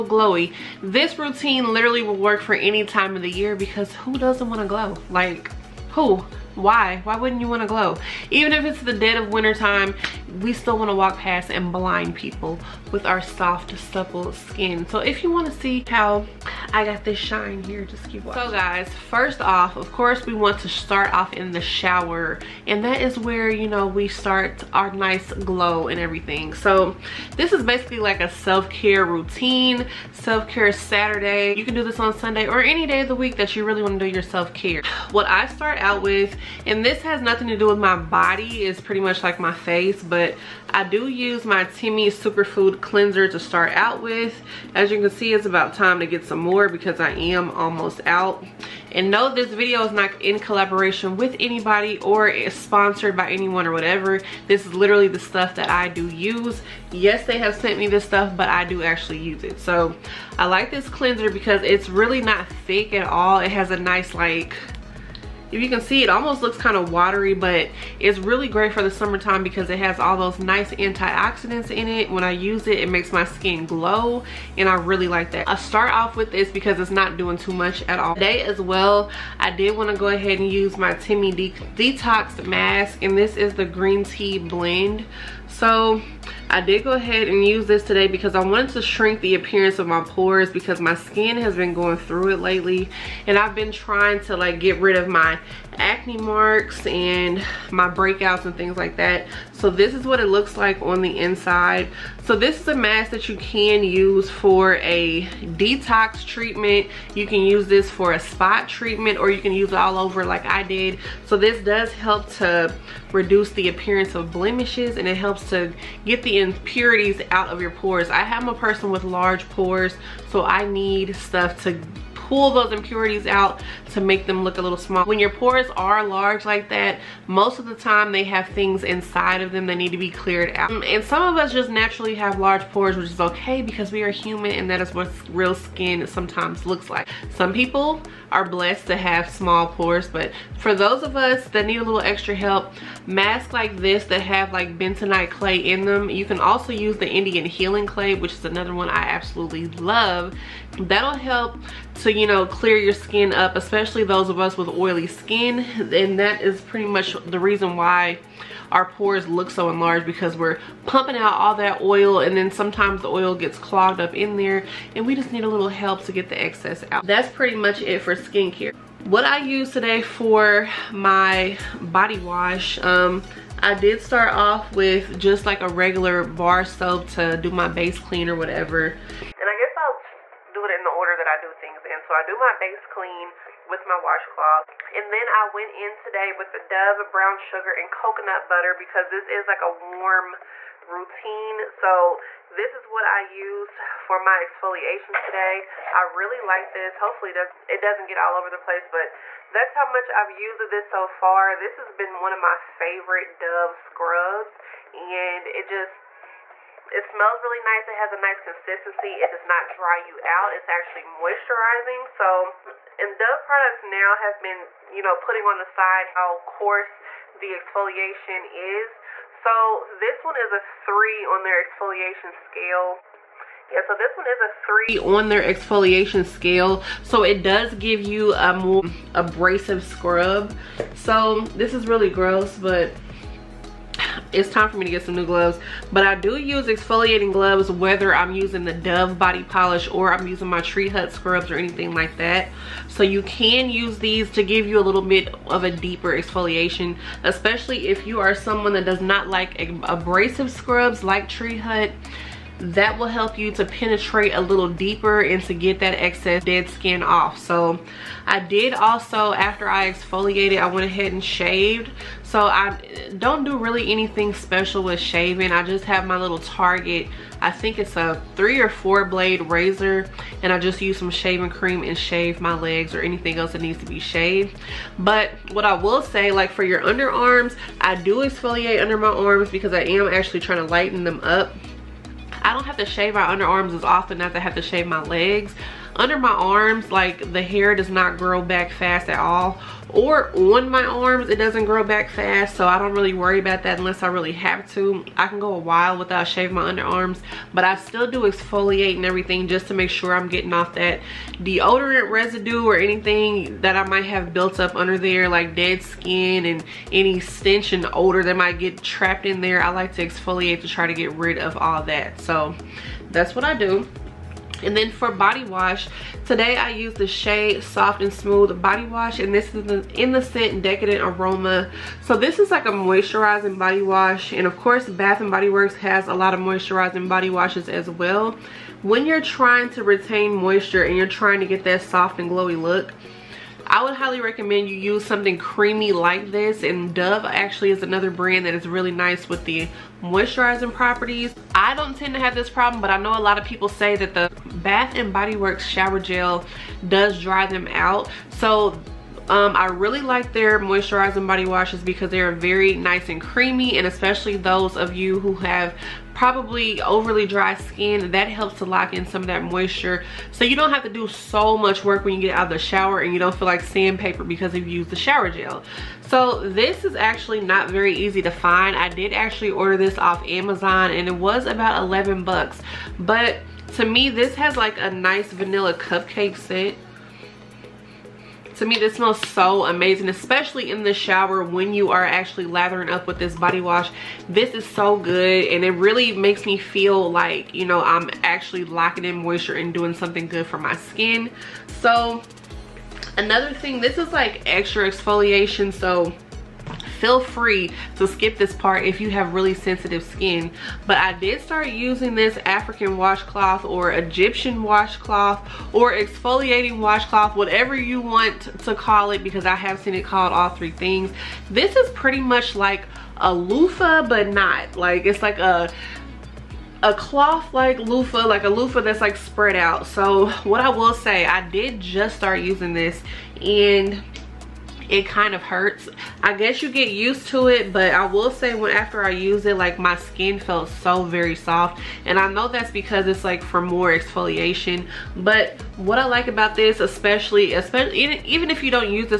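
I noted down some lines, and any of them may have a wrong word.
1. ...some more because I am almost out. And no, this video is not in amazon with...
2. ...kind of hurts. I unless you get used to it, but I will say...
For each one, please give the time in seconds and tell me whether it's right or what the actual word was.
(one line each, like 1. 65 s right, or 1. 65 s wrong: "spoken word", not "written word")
1. 46 s wrong: "collaboration", not "amazon"
2. 425 s wrong: "guess", not "unless".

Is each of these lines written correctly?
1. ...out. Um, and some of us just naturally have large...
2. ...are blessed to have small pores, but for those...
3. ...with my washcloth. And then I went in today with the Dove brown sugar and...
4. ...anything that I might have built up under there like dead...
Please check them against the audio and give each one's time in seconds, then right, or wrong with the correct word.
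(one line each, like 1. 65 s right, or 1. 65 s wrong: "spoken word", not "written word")
1. 130 s right
2. 138 s right
3. 183 s right
4. 302 s right.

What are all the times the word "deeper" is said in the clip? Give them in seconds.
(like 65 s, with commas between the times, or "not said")
245 s, 254 s.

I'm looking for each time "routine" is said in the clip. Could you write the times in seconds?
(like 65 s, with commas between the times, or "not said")
1 s, 29 s, 190 s.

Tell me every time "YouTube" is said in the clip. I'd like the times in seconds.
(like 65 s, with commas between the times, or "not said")
not said.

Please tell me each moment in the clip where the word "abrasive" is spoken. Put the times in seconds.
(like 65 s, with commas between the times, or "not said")
229 s, 249 s.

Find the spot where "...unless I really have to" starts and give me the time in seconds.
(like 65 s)
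293 s.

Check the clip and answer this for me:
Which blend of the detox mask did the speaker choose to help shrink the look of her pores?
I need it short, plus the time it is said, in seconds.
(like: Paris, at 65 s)
green tea, at 83 s.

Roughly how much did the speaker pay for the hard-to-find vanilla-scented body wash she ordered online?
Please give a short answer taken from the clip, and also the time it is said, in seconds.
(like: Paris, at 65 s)
$11, at 371 s.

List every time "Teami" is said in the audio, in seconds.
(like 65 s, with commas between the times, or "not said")
41 s, 80 s.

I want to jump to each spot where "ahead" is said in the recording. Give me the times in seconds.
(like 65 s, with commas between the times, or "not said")
80 s, 86 s, 260 s.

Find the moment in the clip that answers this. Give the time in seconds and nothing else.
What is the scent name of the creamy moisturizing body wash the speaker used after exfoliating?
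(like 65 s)
320 s.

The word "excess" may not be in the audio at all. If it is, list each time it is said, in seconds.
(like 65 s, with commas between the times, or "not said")
166 s, 255 s.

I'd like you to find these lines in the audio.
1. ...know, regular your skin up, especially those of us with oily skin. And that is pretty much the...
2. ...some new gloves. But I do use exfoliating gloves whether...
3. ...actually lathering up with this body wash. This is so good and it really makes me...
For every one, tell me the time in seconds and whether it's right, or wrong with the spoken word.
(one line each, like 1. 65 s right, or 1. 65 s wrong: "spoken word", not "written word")
1. 152 s wrong: "clear", not "regular"
2. 235 s right
3. 382 s right.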